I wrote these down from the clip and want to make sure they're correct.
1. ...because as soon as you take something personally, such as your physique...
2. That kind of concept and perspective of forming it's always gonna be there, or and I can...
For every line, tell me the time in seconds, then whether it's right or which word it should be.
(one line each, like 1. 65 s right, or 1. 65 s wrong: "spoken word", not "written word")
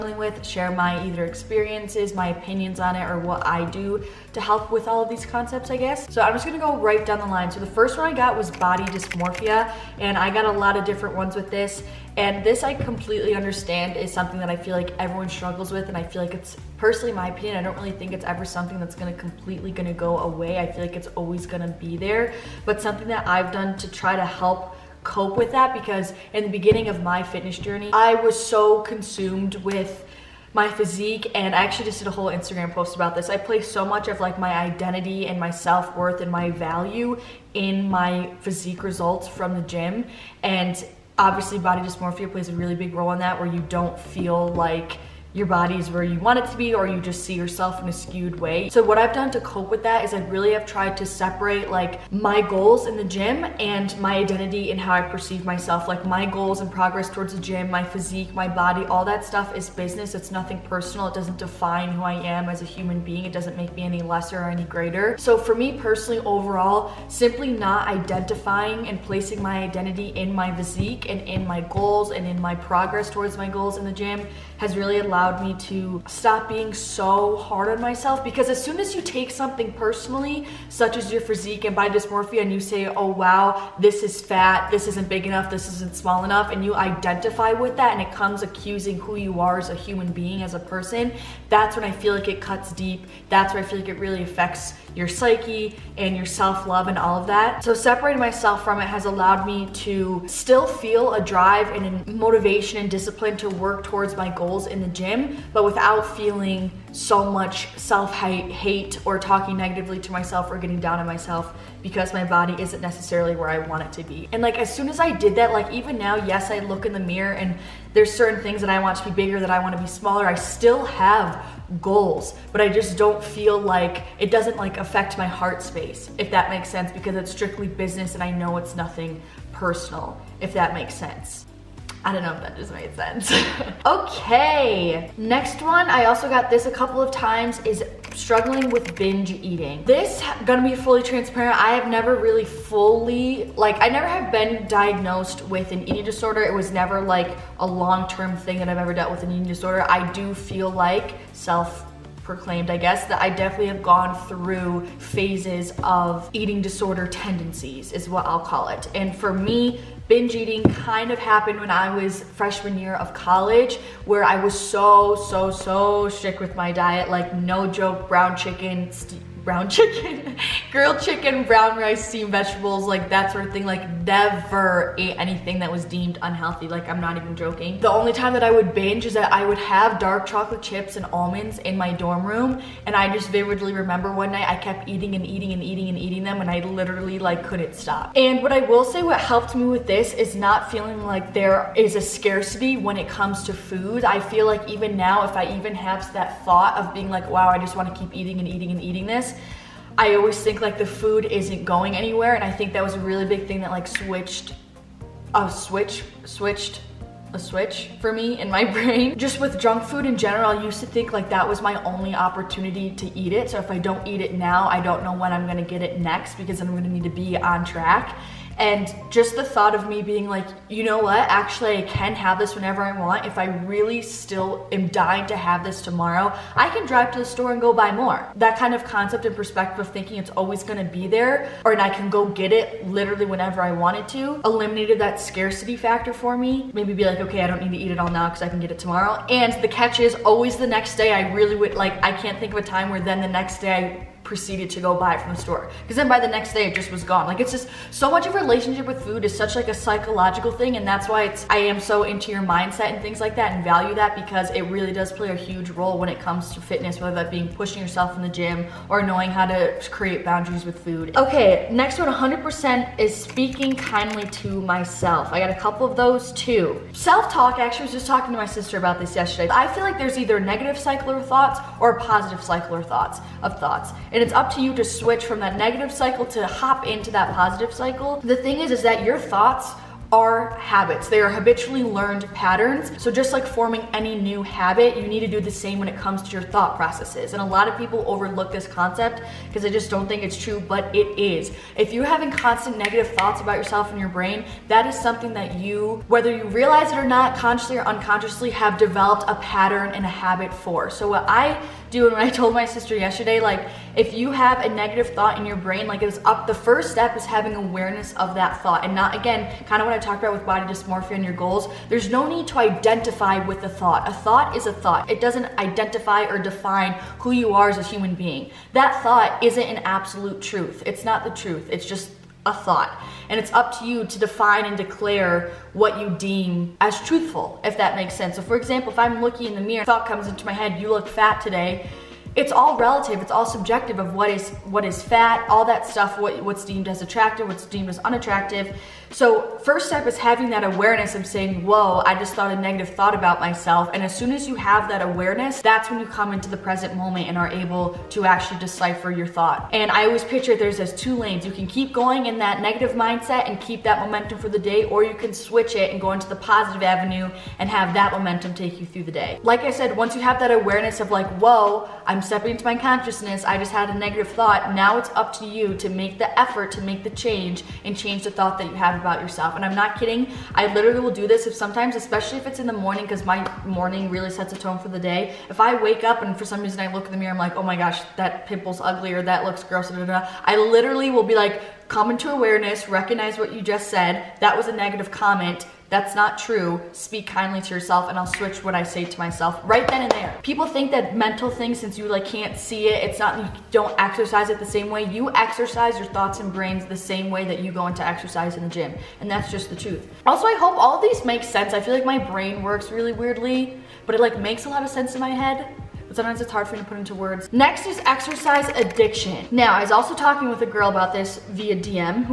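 1. 78 s right
2. 228 s wrong: "thinking", not "forming".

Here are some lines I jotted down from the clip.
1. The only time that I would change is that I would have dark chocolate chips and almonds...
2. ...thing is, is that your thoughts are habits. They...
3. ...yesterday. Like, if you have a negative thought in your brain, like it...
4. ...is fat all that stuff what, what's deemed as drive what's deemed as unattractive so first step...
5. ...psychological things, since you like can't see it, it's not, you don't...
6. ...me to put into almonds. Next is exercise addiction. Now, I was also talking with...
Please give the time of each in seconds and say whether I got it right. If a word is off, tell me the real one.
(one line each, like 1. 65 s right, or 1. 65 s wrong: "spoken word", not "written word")
1. 177 s wrong: "binge", not "change"
2. 278 s right
3. 302 s right
4. 334 s wrong: "attractive", not "drive"
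5. 391 s wrong: "mental", not "psychological"
6. 406 s wrong: "words", not "almonds".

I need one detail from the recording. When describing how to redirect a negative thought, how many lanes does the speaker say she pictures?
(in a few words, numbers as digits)
2.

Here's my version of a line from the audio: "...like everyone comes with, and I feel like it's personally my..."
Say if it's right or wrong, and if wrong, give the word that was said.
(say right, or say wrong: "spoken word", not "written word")
wrong: "struggles", not "comes".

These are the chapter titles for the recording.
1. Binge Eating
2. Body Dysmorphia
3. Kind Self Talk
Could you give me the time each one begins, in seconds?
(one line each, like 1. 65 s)
1. 135 s
2. 6 s
3. 261 s.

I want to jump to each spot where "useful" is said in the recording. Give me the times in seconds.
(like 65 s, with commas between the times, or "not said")
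not said.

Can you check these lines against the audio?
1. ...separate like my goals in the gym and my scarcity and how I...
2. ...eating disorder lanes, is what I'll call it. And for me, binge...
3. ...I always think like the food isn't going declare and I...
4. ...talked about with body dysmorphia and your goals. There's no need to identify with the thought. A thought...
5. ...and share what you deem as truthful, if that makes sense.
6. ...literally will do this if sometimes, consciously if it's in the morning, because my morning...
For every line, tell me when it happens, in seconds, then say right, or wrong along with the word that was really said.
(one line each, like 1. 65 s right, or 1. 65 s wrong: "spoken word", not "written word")
1. 51 s wrong: "identity", not "scarcity"
2. 156 s wrong: "tendencies", not "lanes"
3. 199 s wrong: "anywhere", not "declare"
4. 309 s right
5. 324 s wrong: "declare", not "share"
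6. 370 s wrong: "especially", not "consciously".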